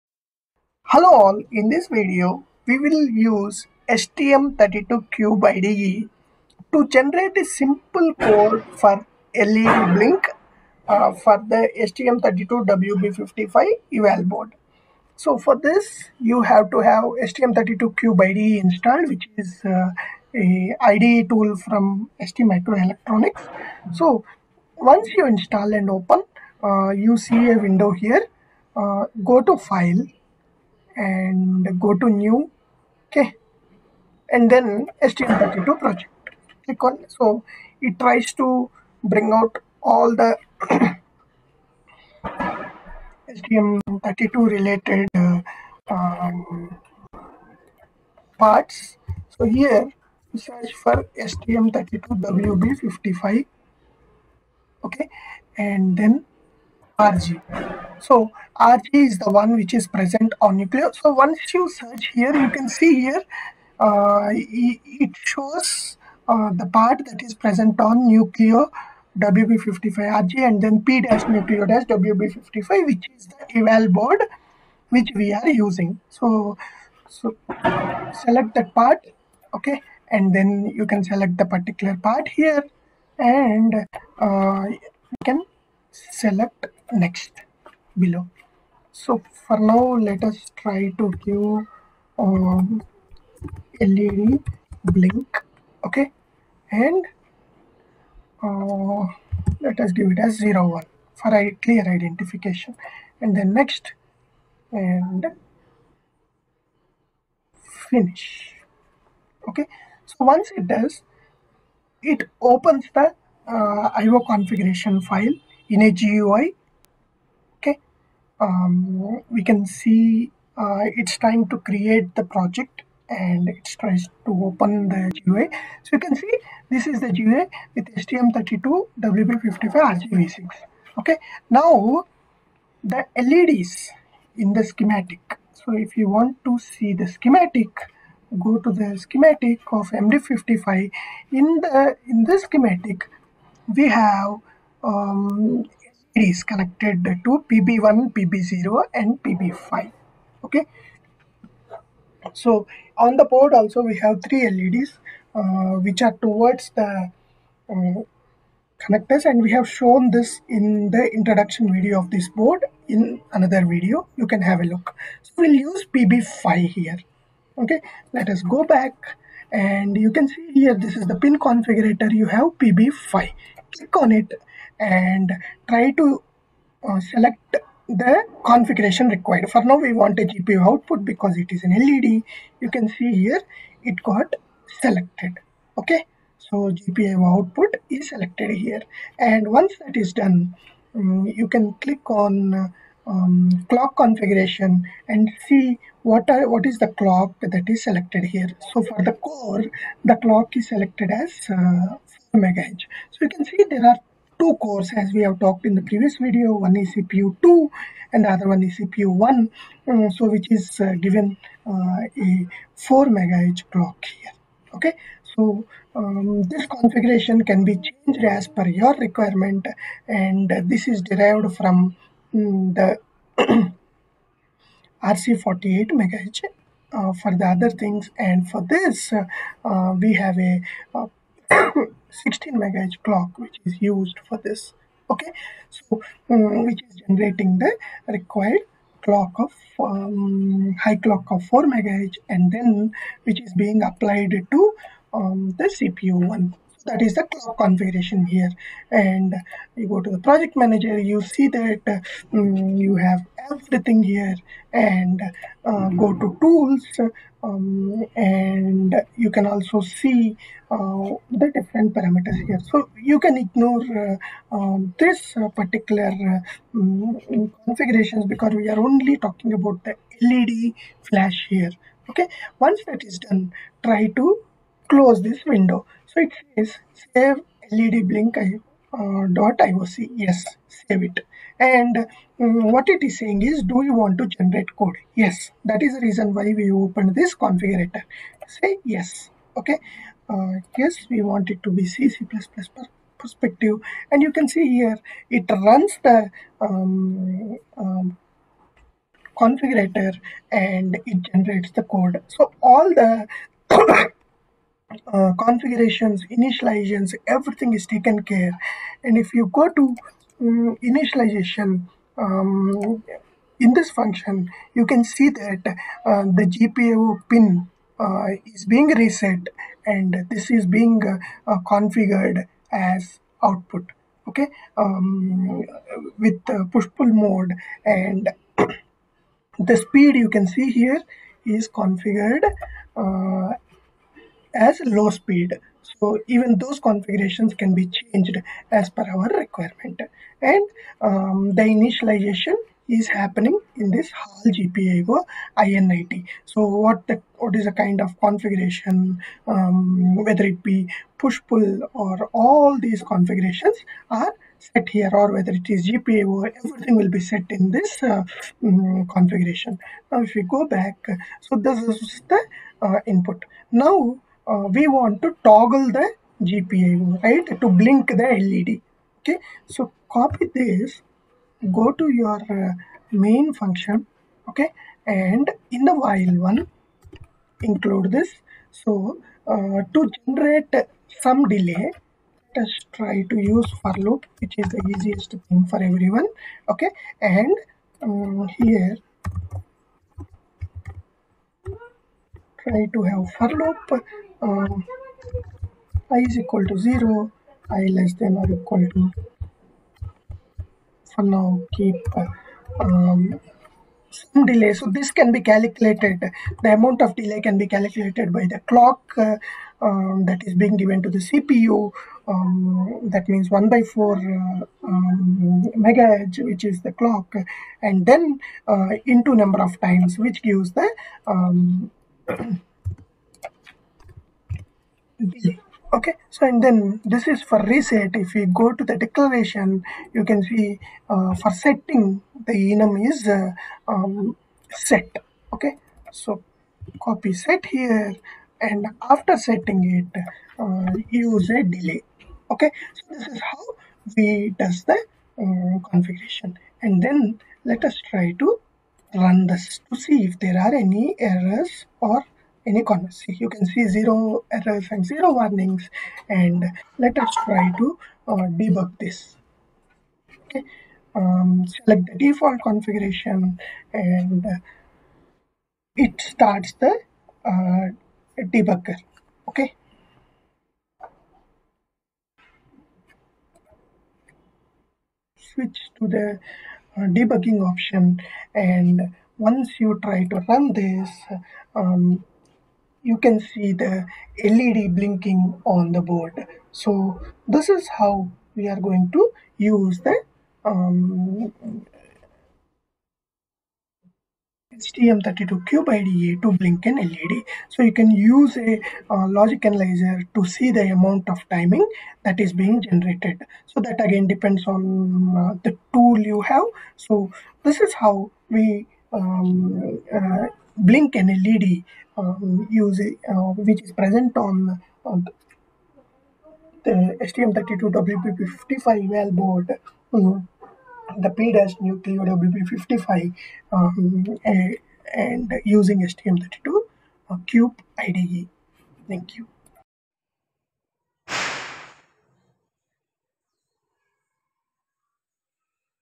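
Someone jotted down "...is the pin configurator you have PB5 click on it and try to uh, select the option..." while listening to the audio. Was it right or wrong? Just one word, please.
wrong.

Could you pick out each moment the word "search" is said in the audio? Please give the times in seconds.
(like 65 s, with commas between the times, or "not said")
50 s, 61 s.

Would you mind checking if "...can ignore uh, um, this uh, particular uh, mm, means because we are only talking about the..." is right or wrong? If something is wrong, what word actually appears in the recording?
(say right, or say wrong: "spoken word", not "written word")
wrong: "configurations", not "means".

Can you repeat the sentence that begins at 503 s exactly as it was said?
So that again depends on uh, the tool you have.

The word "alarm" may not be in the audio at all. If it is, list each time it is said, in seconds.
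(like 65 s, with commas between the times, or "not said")
not said.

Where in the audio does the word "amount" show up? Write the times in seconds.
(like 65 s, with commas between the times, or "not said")
406 s, 500 s.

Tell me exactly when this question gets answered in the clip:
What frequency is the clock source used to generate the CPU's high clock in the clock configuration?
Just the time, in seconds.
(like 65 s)
231 s.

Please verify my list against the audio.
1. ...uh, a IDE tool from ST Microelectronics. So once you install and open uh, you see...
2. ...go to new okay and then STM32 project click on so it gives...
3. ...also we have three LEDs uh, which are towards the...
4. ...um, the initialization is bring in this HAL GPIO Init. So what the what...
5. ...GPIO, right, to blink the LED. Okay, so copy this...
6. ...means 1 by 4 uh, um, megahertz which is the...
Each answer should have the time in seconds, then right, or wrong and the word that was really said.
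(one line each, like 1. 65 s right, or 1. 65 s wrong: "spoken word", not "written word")
1. 19 s right
2. 31 s wrong: "tries", not "gives"
3. 153 s right
4. 341 s wrong: "happening", not "bring"
5. 366 s right
6. 413 s right.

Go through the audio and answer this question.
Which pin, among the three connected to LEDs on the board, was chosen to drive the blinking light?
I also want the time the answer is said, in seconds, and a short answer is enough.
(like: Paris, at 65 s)
PB5, at 165 s.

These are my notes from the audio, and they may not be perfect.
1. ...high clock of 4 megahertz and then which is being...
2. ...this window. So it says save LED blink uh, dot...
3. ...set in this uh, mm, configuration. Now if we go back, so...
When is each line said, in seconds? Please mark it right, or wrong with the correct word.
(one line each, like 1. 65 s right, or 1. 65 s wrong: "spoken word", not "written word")
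1. 240 s right
2. 275 s right
3. 357 s right.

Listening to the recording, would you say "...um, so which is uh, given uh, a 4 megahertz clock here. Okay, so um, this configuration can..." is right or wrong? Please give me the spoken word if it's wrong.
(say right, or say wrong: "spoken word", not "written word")
right.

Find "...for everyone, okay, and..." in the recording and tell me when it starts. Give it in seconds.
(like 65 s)
385 s.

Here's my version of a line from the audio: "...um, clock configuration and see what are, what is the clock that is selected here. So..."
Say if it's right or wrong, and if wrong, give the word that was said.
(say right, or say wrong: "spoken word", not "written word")
right.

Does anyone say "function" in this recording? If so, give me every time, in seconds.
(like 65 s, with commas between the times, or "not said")
313 s, 373 s.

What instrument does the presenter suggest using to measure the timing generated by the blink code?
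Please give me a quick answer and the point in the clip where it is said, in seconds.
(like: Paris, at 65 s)
logic analyzer, at 499 s.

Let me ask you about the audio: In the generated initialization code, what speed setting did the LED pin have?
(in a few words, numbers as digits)
low speed.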